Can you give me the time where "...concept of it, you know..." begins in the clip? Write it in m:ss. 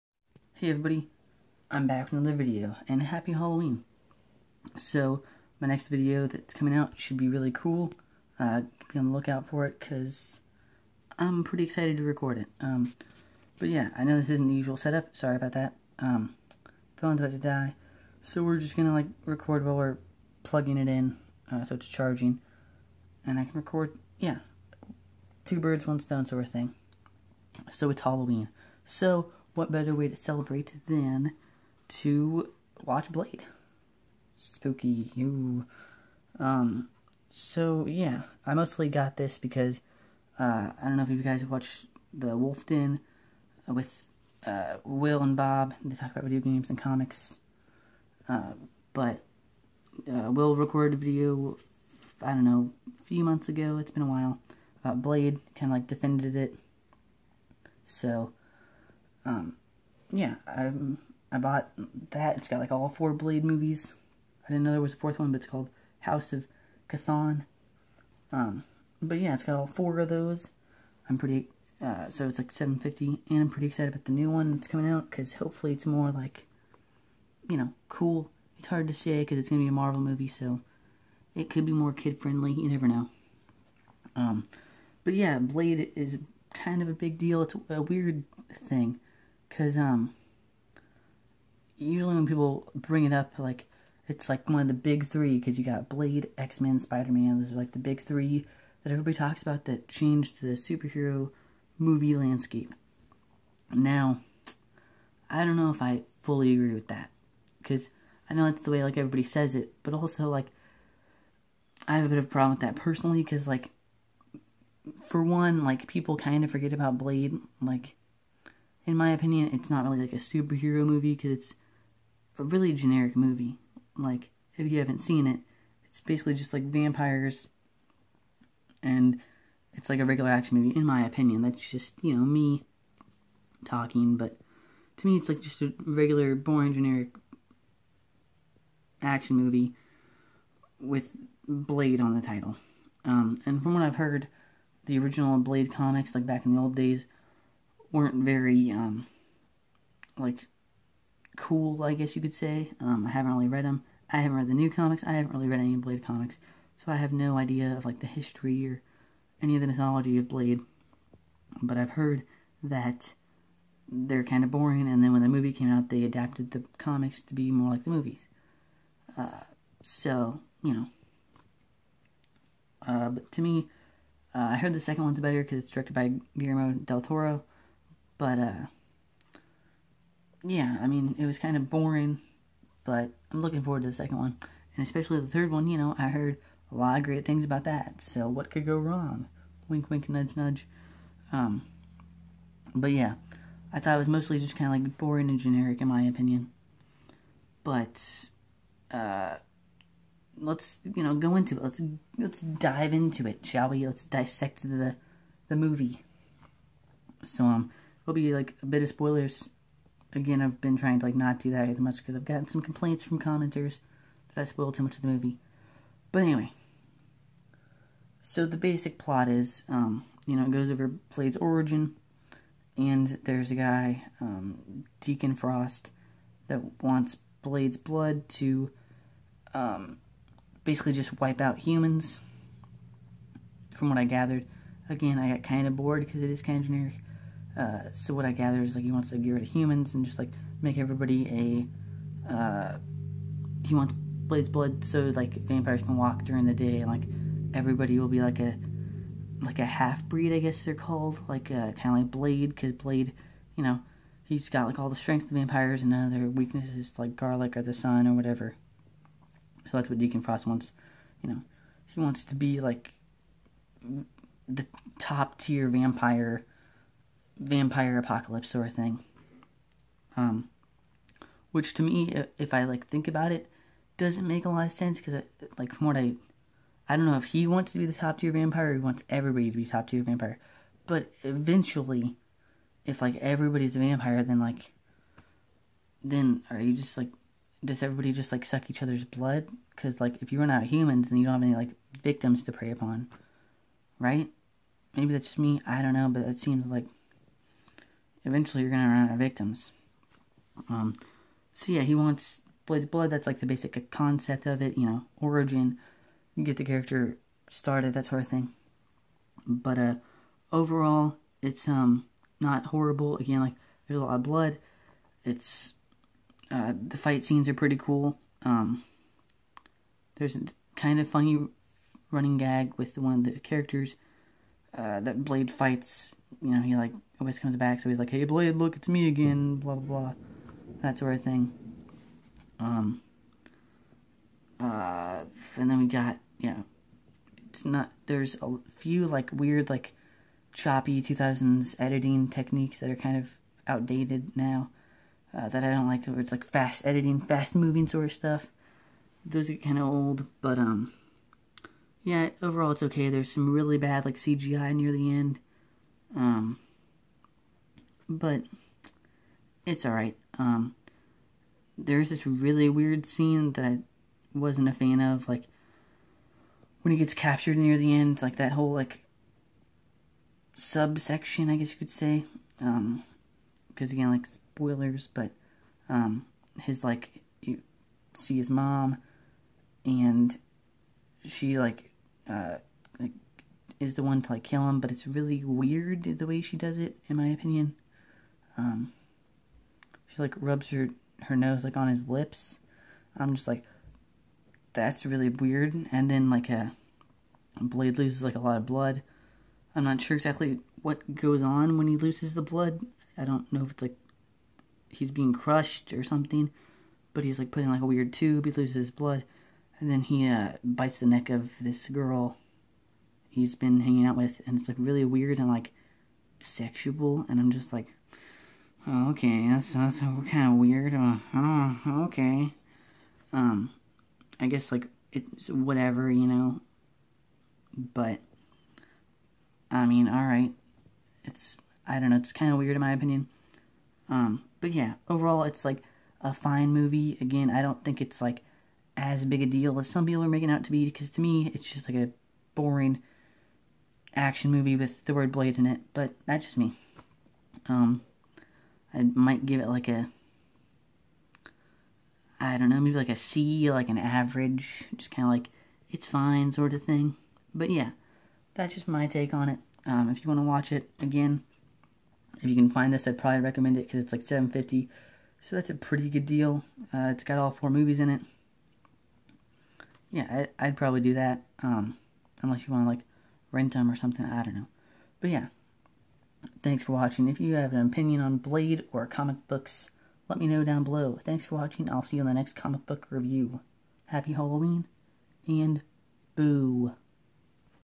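5:03.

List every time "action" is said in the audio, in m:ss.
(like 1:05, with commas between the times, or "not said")
2:10, 2:19, 7:24.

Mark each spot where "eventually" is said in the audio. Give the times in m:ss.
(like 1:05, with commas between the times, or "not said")
4:41, 4:58.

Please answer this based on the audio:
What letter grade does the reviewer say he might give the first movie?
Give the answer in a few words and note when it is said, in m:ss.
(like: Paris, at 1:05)
C, at 7:33.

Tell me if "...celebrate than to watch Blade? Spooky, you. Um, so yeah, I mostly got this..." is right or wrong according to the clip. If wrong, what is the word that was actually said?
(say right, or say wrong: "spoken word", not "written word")
right.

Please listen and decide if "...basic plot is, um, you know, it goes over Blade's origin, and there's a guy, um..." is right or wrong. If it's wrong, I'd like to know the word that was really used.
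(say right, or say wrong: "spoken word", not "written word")
right.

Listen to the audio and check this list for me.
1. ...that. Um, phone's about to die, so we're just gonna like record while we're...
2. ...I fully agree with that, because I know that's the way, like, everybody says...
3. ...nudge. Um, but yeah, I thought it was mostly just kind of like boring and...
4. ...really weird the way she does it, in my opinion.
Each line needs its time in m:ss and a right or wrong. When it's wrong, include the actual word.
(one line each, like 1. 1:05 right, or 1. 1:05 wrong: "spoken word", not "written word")
1. 0:15 right
2. 1:45 right
3. 3:10 right
4. 6:25 right.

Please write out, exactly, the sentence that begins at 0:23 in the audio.
And I can record, yeah, two birds, one stone sort of thing.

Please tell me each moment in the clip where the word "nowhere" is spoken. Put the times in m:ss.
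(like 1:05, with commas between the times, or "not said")
not said.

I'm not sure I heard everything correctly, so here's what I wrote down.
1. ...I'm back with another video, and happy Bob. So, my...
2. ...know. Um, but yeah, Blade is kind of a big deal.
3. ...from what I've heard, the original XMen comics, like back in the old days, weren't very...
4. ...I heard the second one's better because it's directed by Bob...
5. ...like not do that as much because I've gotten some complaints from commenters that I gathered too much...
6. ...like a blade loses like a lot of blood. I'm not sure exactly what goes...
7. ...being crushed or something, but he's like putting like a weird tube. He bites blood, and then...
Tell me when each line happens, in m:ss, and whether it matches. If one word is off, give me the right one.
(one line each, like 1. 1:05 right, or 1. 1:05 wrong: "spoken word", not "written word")
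1. 0:01 wrong: "Halloween", not "Bob"
2. 1:22 right
3. 2:23 wrong: "Blade", not "XMen"
4. 2:54 wrong: "Guillermo", not "Bob"
5. 3:31 wrong: "spoiled", not "gathered"
6. 6:36 right
7. 6:45 wrong: "loses", not "bites".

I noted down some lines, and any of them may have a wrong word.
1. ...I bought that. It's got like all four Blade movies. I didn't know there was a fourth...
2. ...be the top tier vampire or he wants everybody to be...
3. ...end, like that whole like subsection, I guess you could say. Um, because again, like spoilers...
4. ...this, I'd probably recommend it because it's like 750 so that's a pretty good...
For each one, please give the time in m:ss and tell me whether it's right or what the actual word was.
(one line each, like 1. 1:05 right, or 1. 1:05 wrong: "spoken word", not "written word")
1. 1:01 right
2. 4:37 right
3. 6:07 right
4. 7:42 right.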